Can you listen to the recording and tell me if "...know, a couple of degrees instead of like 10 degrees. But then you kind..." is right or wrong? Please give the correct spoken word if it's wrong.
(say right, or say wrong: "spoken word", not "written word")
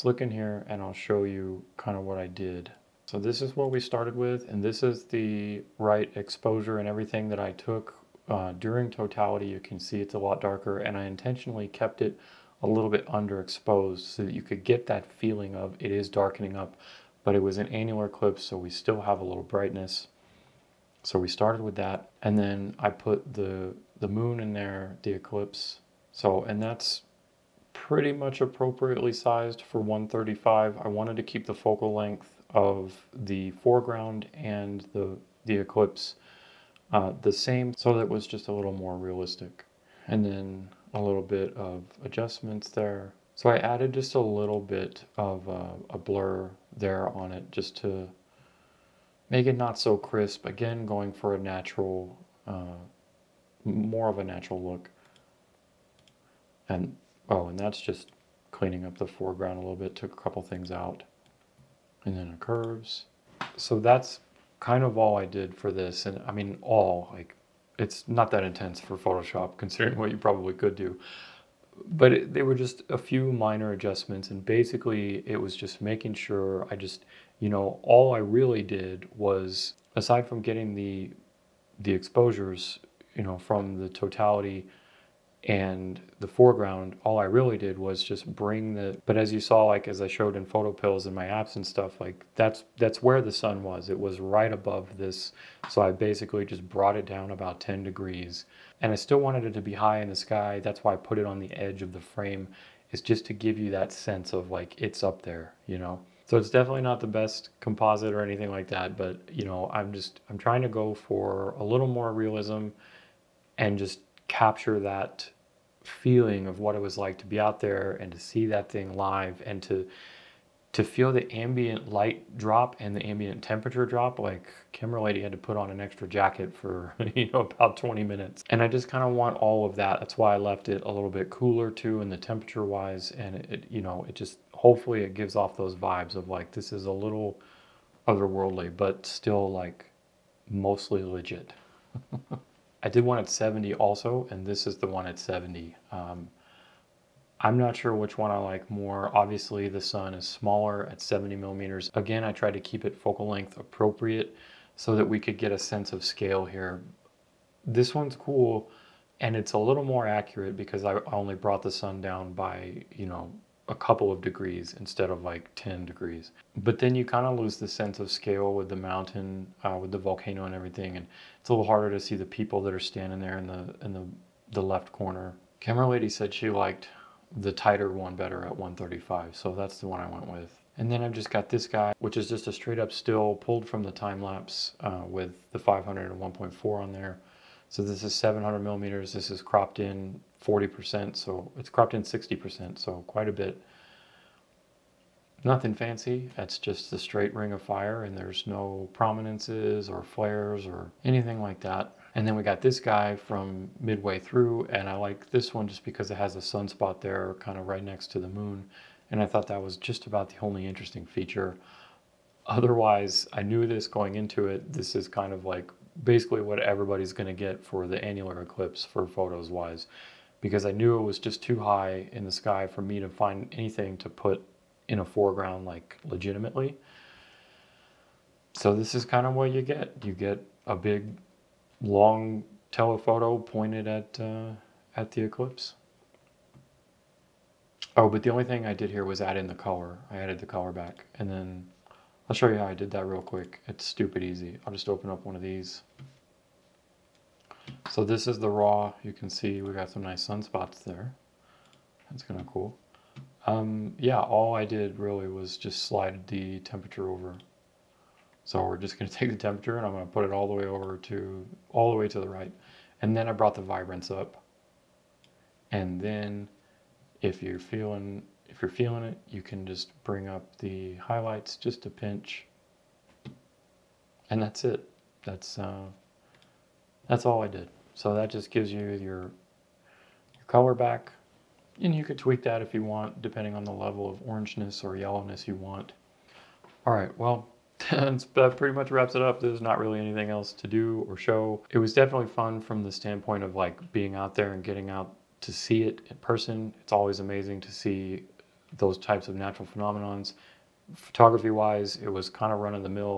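right.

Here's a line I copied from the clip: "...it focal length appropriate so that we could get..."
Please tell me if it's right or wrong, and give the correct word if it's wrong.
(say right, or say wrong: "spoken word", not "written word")
right.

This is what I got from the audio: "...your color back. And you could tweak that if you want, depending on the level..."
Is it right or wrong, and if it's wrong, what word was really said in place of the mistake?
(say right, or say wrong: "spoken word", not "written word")
right.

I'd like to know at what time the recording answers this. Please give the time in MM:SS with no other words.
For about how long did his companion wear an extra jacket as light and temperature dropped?
02:07.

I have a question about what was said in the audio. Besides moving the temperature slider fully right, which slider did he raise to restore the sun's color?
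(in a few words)
vibrance.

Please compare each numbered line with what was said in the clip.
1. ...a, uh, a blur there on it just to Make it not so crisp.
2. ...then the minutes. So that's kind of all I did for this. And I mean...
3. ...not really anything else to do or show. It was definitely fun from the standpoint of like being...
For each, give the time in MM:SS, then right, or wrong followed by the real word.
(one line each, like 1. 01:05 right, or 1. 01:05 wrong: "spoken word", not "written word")
1. 00:45 right
2. 01:02 wrong: "curves", not "minutes"
3. 04:49 right.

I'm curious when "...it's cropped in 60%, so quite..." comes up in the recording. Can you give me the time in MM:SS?
03:11.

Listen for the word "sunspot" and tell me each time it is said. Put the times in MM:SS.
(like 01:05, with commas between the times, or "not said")
03:26, 04:10.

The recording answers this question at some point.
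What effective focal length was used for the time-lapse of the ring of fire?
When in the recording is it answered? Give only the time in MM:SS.
03:08.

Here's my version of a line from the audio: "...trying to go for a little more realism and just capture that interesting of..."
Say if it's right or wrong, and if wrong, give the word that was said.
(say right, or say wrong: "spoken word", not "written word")
wrong: "feeling", not "interesting".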